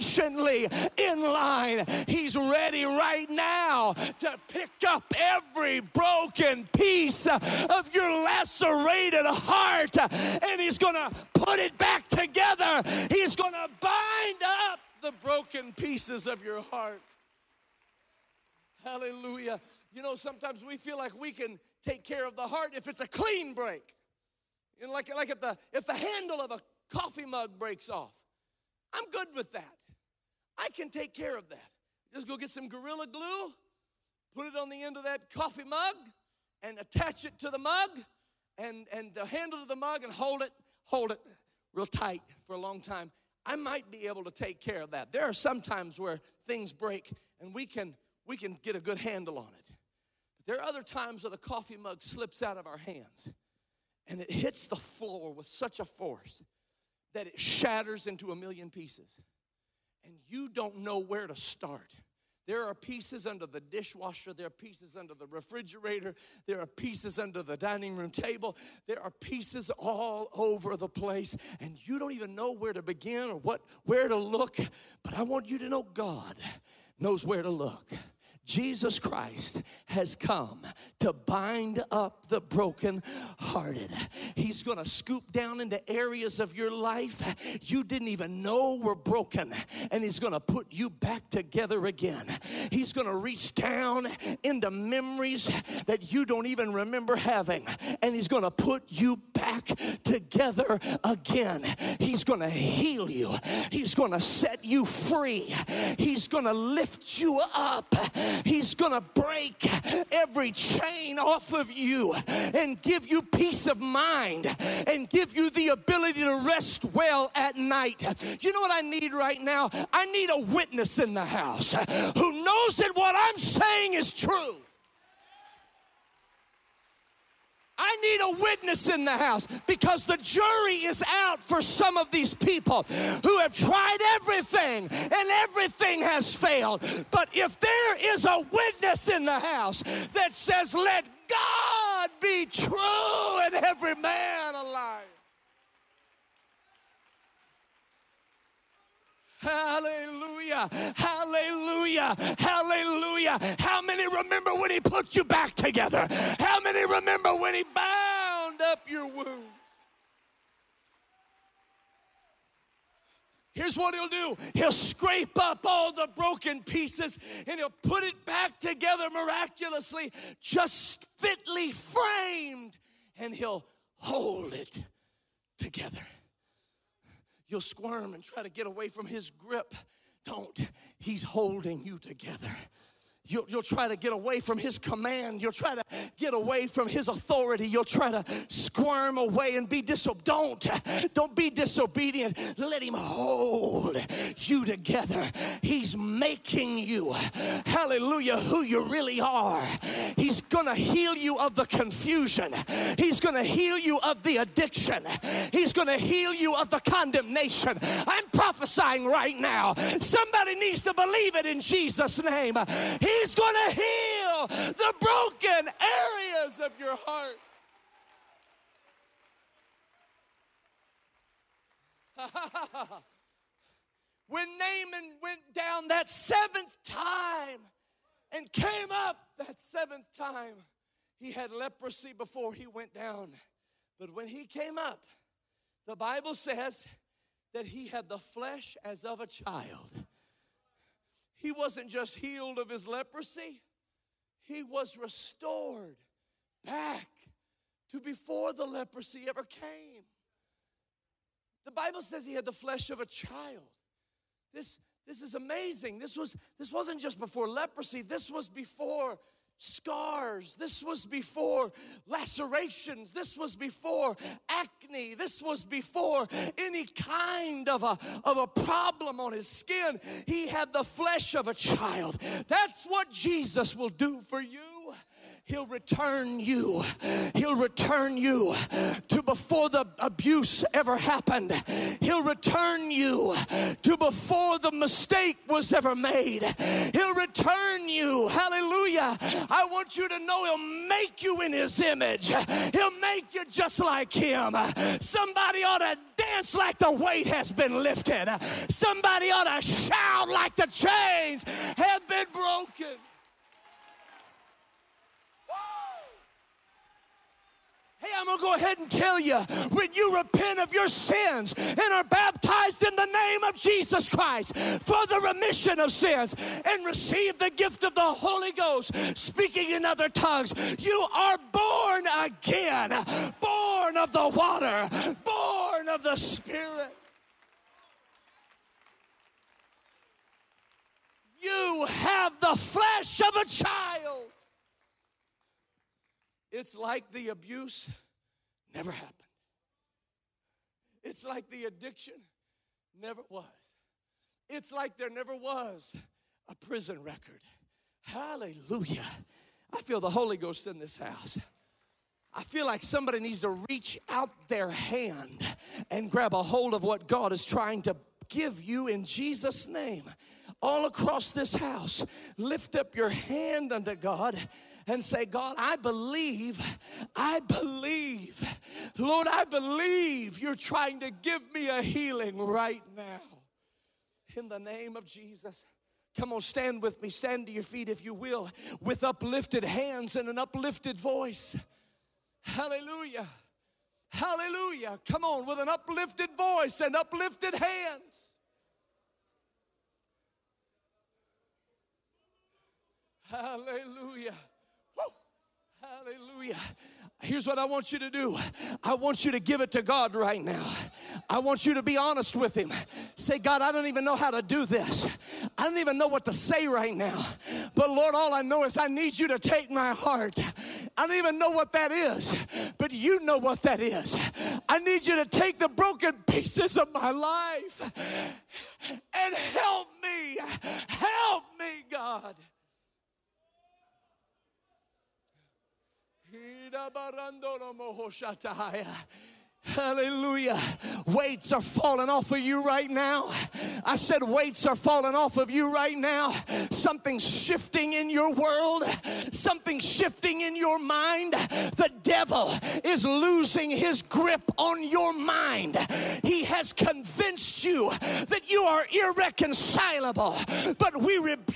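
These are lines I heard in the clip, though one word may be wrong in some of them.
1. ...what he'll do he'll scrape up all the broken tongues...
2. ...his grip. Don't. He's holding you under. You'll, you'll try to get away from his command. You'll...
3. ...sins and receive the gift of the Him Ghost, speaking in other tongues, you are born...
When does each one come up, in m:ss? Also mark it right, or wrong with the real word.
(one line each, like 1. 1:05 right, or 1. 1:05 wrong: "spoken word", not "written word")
1. 2:43 wrong: "pieces", not "tongues"
2. 2:59 wrong: "together", not "under"
3. 5:15 wrong: "Holy", not "Him".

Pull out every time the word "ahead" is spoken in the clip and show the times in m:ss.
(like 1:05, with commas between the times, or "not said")
5:08.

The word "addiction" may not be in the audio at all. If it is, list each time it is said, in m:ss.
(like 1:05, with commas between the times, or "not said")
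3:24, 5:41.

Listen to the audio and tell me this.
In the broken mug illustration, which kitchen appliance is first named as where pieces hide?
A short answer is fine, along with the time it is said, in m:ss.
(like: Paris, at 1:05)
dishwasher, at 1:03.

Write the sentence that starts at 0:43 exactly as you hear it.
I might be able to take care of that.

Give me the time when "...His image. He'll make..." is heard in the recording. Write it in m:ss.
4:51.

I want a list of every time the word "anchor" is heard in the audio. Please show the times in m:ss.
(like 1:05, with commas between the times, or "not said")
not said.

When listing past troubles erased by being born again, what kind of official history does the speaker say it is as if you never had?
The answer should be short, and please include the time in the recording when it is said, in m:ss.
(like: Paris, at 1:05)
prison record, at 5:46.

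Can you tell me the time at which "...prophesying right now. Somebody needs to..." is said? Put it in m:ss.
3:28.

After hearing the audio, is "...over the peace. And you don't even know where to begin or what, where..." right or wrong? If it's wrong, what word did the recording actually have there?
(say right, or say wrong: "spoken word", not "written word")
wrong: "place", not "peace".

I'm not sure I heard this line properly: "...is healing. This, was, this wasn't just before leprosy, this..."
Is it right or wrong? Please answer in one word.
wrong.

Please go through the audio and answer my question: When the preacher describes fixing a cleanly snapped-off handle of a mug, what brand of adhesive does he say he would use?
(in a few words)
Gorilla Glue.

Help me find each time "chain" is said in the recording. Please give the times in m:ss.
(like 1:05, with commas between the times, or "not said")
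1:50, 5:00.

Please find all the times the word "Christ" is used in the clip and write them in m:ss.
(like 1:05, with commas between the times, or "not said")
1:18, 5:14.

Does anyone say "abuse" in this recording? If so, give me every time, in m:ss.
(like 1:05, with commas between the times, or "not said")
4:39, 5:37.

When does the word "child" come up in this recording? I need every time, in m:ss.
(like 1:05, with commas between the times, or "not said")
3:59, 4:13, 4:31, 5:33.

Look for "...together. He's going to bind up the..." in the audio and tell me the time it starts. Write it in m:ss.
0:12.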